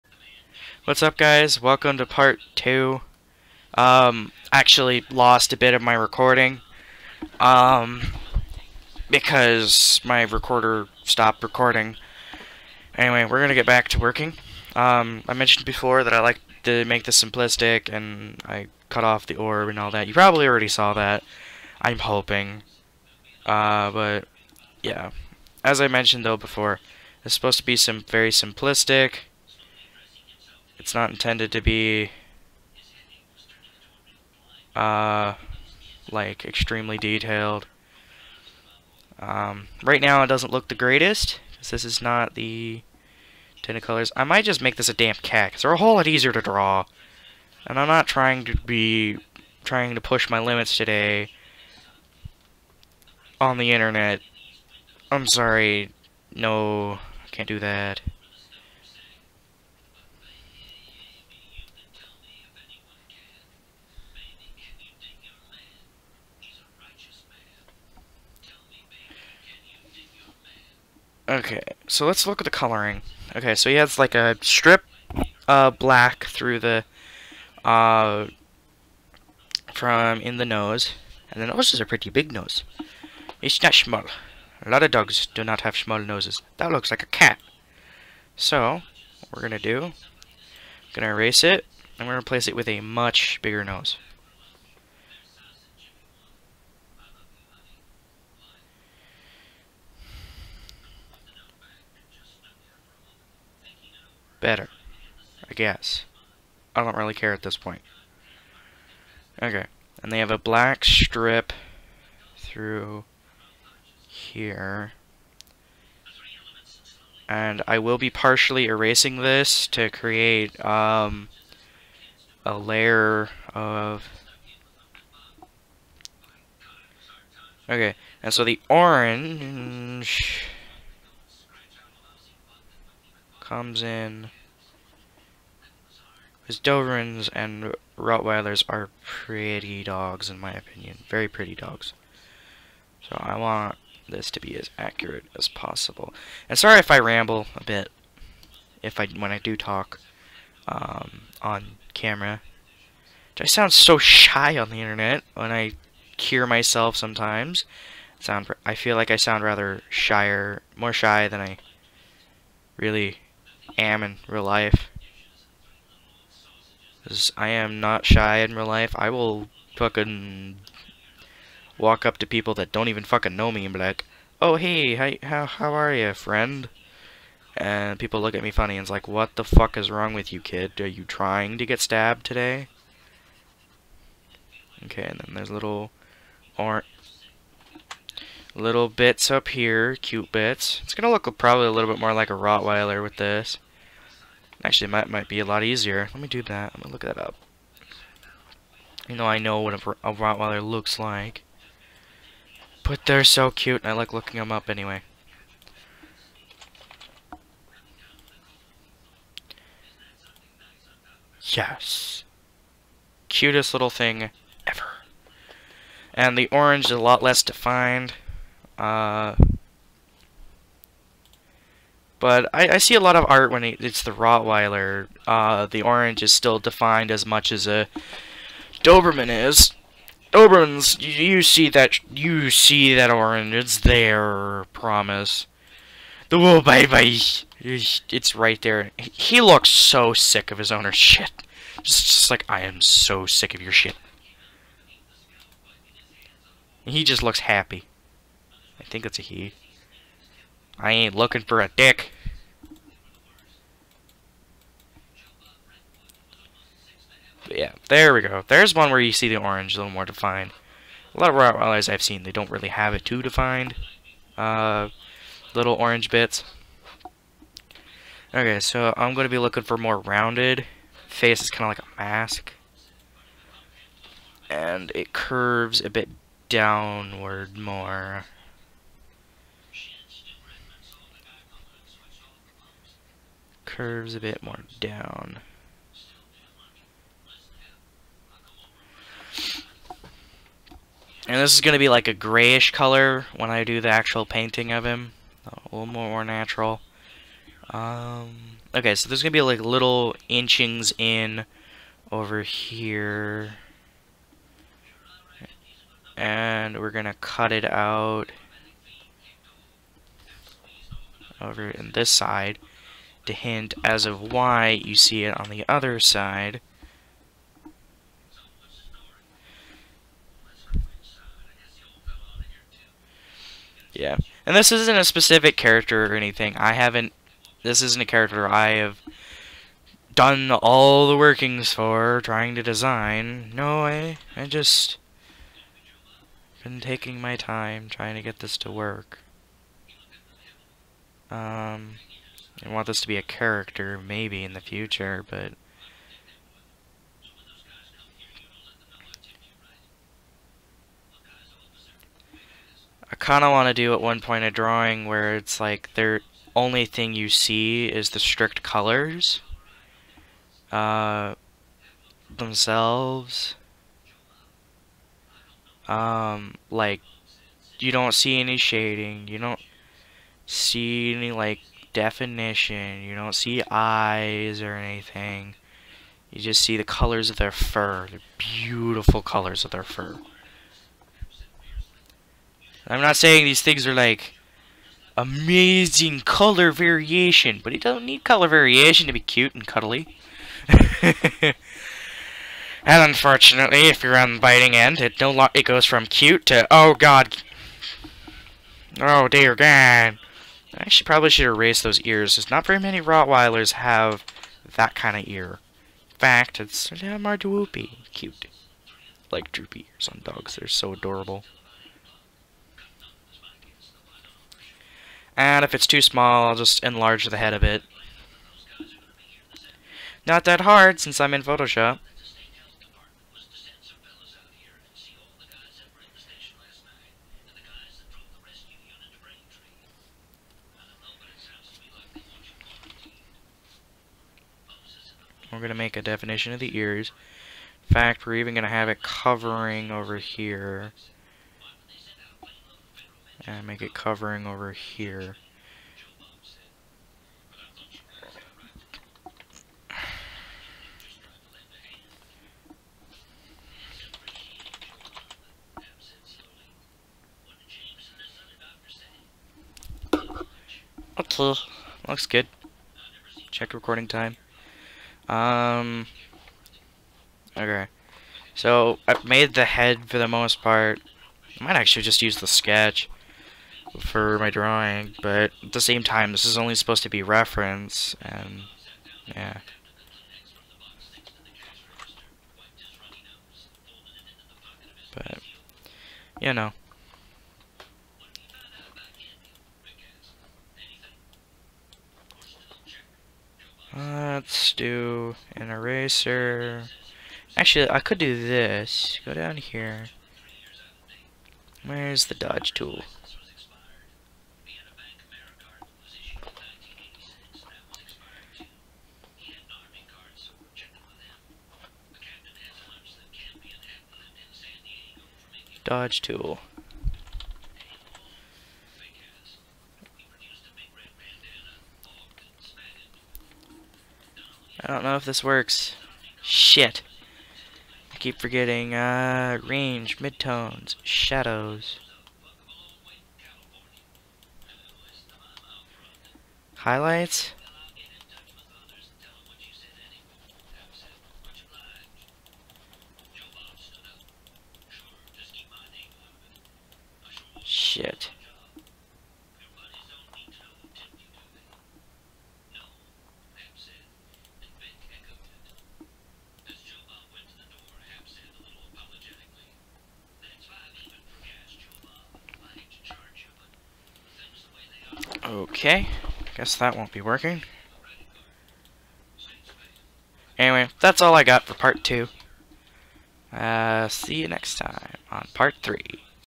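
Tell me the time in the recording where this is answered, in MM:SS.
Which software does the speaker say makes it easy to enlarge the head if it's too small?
07:01.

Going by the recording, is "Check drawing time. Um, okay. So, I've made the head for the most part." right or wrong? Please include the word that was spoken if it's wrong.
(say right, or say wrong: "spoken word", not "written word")
wrong: "recording", not "drawing".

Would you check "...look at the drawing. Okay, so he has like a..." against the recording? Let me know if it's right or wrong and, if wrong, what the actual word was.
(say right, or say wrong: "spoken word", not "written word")
wrong: "coloring", not "drawing".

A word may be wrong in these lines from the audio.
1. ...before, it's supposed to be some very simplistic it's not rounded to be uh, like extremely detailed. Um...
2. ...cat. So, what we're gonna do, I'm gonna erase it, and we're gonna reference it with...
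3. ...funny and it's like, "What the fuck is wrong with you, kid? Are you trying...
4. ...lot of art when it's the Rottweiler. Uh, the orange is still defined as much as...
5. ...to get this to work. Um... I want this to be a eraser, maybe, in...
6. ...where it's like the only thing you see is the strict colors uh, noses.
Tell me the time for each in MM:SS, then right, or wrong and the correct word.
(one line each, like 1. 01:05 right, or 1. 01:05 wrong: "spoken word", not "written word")
1. 00:26 wrong: "intended", not "rounded"
2. 01:27 wrong: "replace", not "reference"
3. 02:58 right
4. 03:42 right
5. 05:38 wrong: "character", not "eraser"
6. 05:55 wrong: "themselves", not "noses".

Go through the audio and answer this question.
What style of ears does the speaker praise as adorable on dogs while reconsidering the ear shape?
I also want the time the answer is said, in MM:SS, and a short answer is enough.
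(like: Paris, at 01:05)
Droopy ears, at 06:49.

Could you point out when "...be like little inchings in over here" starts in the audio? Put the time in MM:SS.
04:59.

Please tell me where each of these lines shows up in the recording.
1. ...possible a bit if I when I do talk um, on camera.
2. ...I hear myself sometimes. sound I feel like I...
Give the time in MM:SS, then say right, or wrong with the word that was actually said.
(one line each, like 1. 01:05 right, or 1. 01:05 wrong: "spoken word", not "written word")
1. 02:26 wrong: "ramble", not "possible"
2. 02:35 right.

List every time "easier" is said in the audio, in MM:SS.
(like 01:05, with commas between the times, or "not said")
00:46, 03:15.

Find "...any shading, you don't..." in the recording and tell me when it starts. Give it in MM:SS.
06:08.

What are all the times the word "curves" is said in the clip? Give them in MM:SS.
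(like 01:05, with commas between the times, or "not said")
04:35, 04:43.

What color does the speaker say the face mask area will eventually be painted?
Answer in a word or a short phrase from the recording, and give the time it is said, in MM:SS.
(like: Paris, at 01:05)
Grayish, at 04:52.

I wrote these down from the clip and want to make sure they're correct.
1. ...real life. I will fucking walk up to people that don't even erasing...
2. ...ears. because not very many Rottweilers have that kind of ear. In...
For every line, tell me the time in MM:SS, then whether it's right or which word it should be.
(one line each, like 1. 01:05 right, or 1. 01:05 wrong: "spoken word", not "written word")
1. 02:48 wrong: "fucking", not "erasing"
2. 06:42 right.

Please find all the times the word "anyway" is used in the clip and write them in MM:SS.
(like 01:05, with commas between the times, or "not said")
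00:12, 03:24, 09:30.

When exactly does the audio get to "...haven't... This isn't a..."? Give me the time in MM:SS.
05:26.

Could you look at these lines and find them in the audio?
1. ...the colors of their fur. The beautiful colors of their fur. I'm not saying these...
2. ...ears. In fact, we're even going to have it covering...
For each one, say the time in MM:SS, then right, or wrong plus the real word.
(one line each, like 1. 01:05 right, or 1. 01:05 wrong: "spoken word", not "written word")
1. 06:16 right
2. 07:16 right.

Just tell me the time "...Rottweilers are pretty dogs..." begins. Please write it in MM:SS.
02:17.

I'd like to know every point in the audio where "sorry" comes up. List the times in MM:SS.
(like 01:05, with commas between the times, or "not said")
00:55, 02:26.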